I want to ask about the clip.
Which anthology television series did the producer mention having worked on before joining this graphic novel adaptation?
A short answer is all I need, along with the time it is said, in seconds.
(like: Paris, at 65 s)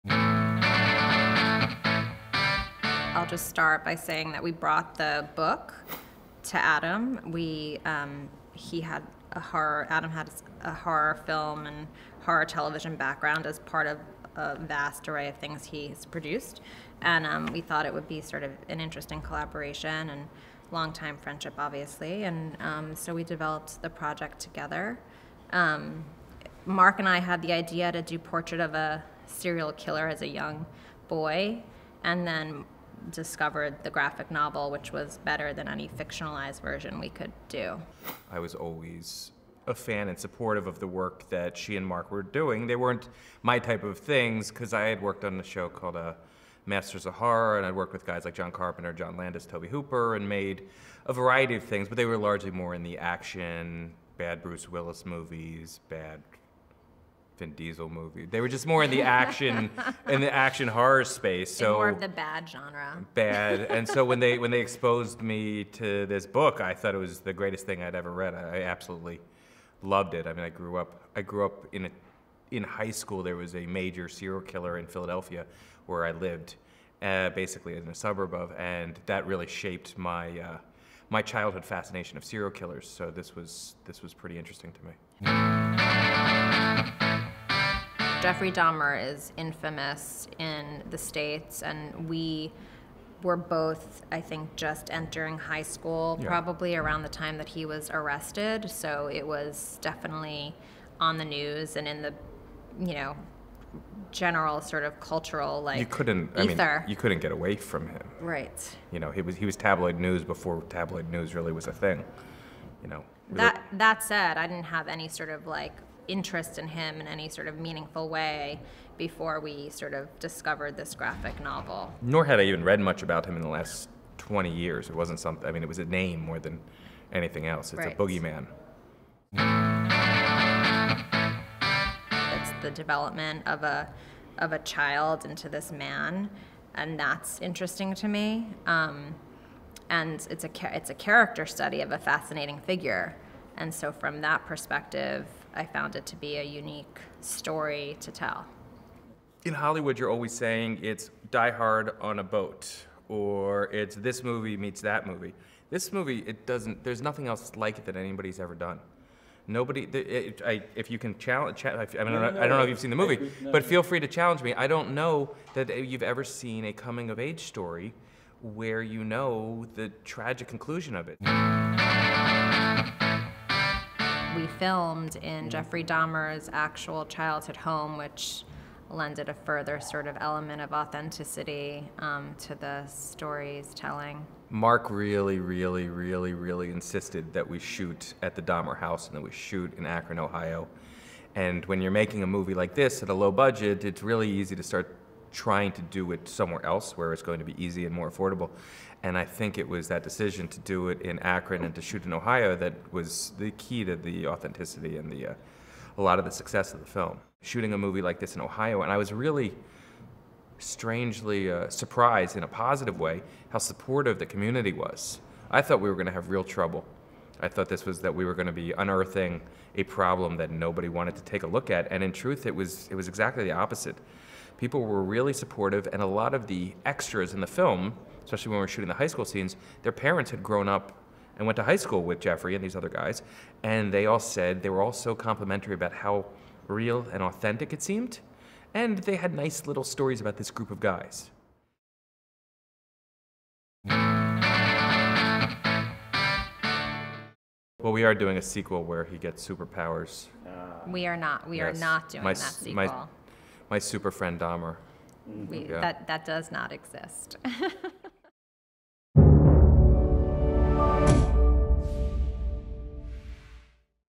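Masters of Horror, at 46 s.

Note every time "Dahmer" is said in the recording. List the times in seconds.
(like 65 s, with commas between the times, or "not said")
88 s, 175 s, 188 s, 254 s.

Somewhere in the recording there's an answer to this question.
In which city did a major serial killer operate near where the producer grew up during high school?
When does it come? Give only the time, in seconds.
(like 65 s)
74 s.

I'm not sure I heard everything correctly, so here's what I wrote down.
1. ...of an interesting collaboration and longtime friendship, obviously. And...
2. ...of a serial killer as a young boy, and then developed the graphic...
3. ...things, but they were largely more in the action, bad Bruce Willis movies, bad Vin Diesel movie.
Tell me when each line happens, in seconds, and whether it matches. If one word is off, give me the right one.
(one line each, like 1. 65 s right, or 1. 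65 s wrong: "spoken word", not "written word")
1. 18 s right
2. 28 s wrong: "discovered", not "developed"
3. 51 s right.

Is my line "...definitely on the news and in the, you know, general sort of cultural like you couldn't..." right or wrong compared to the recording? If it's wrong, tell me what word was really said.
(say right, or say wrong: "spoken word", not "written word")
right.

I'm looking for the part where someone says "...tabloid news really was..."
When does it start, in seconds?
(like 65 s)
110 s.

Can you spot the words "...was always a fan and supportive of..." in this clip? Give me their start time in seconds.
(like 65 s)
38 s.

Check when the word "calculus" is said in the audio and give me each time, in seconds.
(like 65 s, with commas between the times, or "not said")
not said.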